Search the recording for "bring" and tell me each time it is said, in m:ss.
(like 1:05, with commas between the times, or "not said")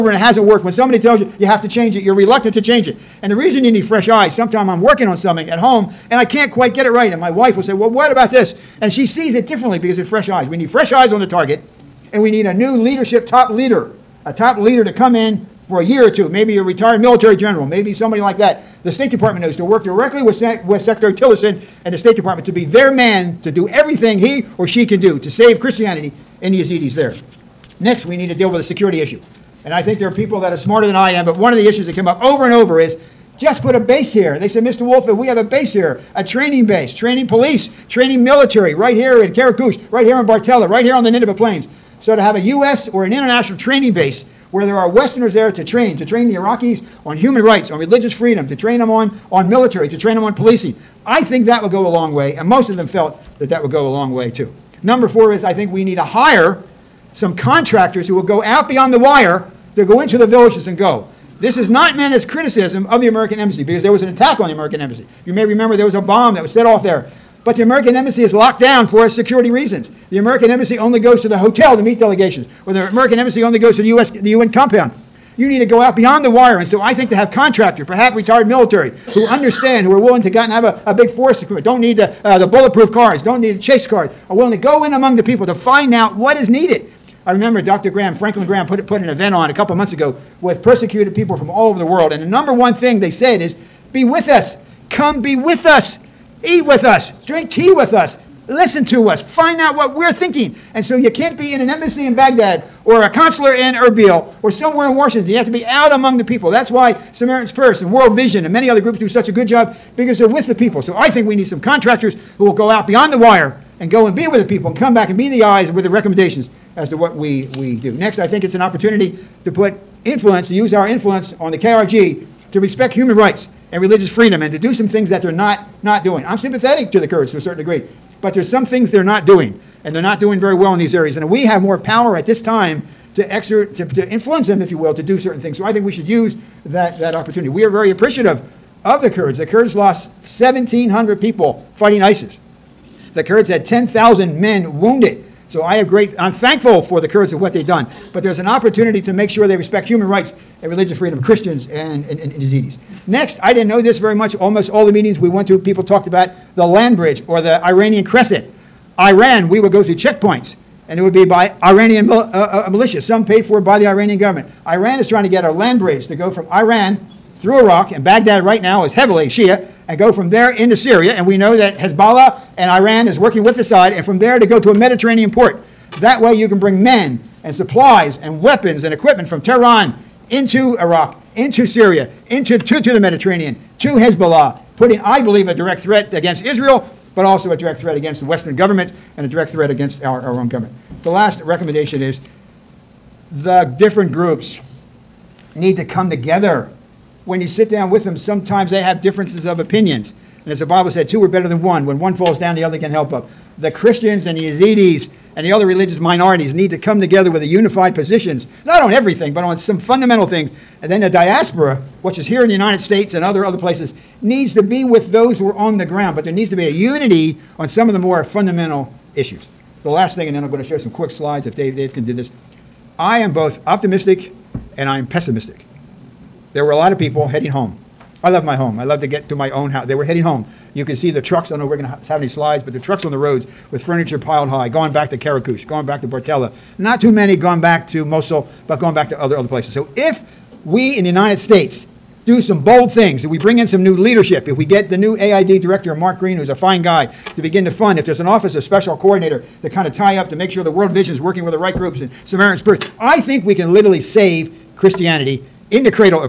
2:56, 4:03.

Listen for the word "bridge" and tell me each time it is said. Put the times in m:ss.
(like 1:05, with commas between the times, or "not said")
2:36, 2:45.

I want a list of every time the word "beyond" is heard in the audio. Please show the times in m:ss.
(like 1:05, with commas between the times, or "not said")
0:58, 1:15, 1:52.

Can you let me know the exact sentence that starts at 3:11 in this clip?
The last recommendation is the different groups need to come together.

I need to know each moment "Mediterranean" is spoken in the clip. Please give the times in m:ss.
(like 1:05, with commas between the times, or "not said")
2:54, 3:02.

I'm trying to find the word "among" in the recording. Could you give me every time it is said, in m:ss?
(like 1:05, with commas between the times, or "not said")
1:24, 1:45.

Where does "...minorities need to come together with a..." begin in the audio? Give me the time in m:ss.
3:25.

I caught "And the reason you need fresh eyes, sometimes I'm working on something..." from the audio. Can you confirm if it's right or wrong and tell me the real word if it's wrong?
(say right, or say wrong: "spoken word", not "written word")
right.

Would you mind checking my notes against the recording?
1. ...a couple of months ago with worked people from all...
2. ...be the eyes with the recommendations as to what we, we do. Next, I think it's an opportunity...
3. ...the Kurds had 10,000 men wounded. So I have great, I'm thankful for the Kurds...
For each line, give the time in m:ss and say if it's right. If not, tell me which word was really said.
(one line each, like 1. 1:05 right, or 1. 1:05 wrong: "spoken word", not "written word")
1. 1:29 wrong: "persecuted", not "worked"
2. 1:55 right
3. 2:23 right.